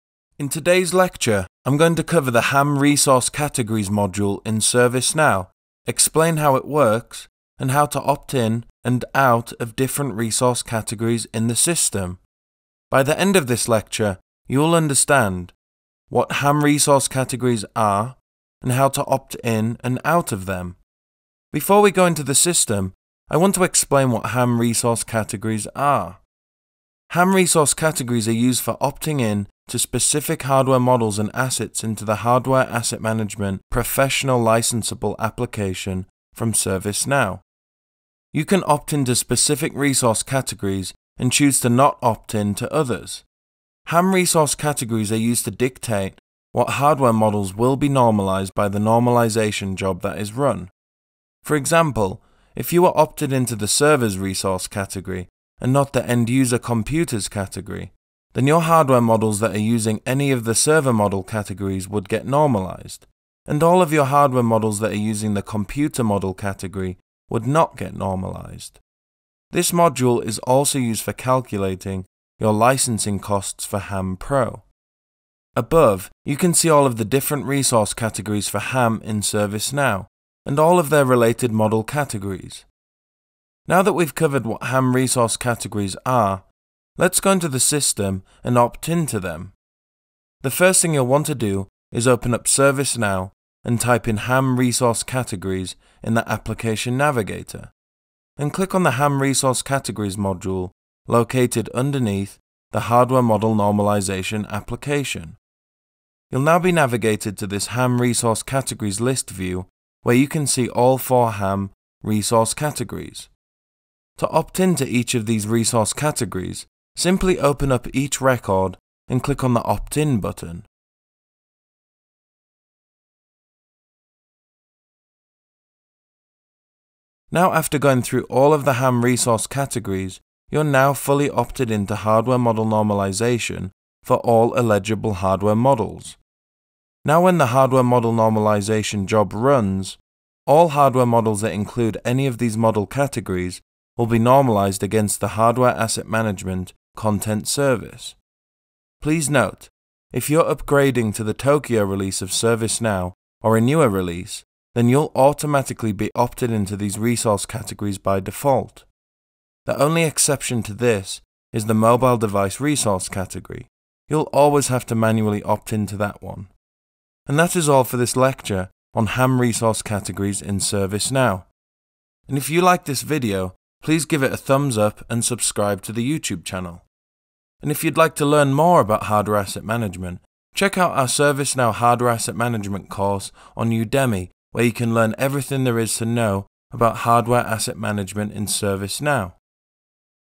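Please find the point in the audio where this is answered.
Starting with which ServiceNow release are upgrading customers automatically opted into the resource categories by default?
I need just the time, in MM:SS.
02:31.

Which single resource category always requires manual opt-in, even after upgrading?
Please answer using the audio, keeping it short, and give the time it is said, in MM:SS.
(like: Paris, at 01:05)
mobile device, at 02:41.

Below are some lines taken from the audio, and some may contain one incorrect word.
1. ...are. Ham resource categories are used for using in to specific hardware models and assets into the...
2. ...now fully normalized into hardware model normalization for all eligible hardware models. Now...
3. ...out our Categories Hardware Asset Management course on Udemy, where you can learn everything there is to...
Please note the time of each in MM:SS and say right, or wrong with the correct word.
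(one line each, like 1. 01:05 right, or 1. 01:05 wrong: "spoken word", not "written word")
1. 00:25 wrong: "opting", not "using"
2. 02:10 wrong: "opted", not "normalized"
3. 03:00 wrong: "ServiceNow", not "Categories".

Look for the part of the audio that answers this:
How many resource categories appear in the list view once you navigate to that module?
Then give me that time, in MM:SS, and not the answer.
01:50.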